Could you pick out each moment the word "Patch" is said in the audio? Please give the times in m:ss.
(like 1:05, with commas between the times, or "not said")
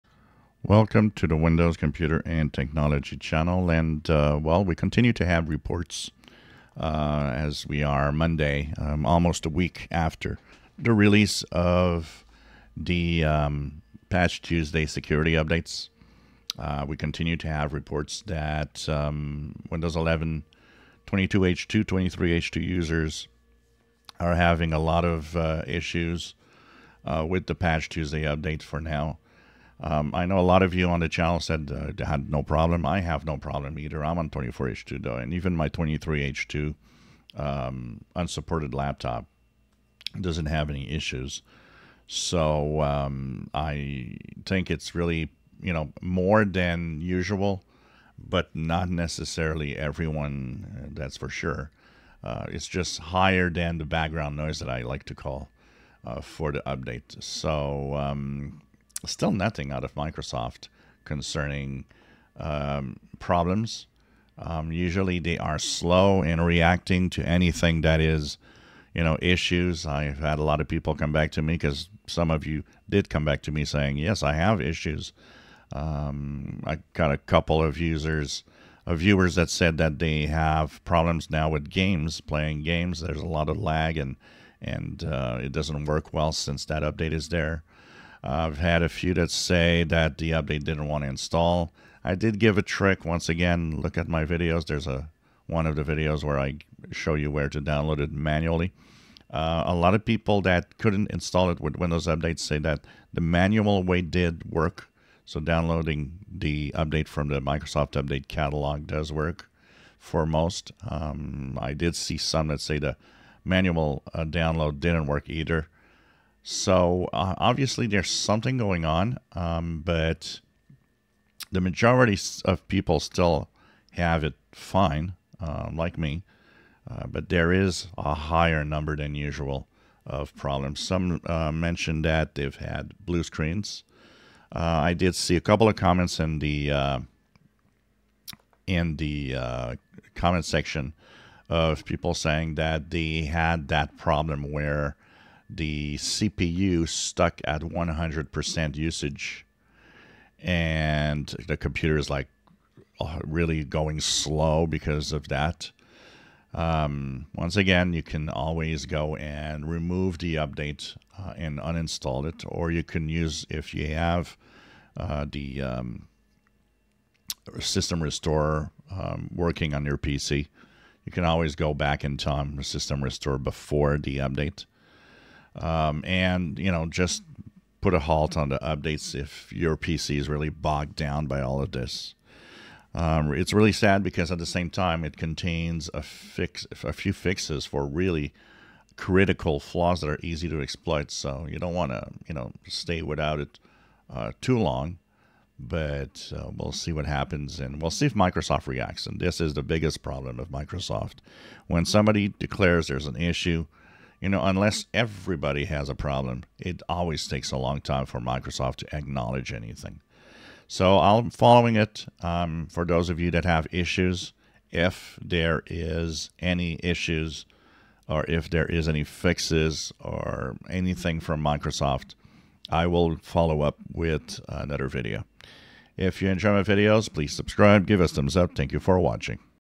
0:14, 0:27.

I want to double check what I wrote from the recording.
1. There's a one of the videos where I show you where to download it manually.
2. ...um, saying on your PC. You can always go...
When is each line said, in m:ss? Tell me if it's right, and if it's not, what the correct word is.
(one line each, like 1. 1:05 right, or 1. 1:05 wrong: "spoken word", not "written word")
1. 1:34 right
2. 2:48 wrong: "working", not "saying".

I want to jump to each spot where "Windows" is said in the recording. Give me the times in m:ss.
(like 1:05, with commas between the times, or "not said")
0:01, 0:19, 1:41.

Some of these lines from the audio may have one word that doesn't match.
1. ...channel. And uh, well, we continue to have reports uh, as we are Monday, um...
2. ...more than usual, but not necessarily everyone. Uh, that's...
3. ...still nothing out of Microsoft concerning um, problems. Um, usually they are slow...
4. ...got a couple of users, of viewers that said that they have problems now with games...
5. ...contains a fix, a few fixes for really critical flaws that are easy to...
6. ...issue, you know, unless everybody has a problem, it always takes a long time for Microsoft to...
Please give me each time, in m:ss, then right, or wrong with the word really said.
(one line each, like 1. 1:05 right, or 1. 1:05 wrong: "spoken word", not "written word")
1. 0:03 right
2. 0:45 right
3. 0:59 right
4. 1:16 right
5. 3:05 right
6. 3:23 right.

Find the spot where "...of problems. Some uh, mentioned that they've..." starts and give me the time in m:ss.
2:10.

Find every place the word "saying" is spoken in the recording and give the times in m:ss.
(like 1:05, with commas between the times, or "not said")
1:13, 2:22.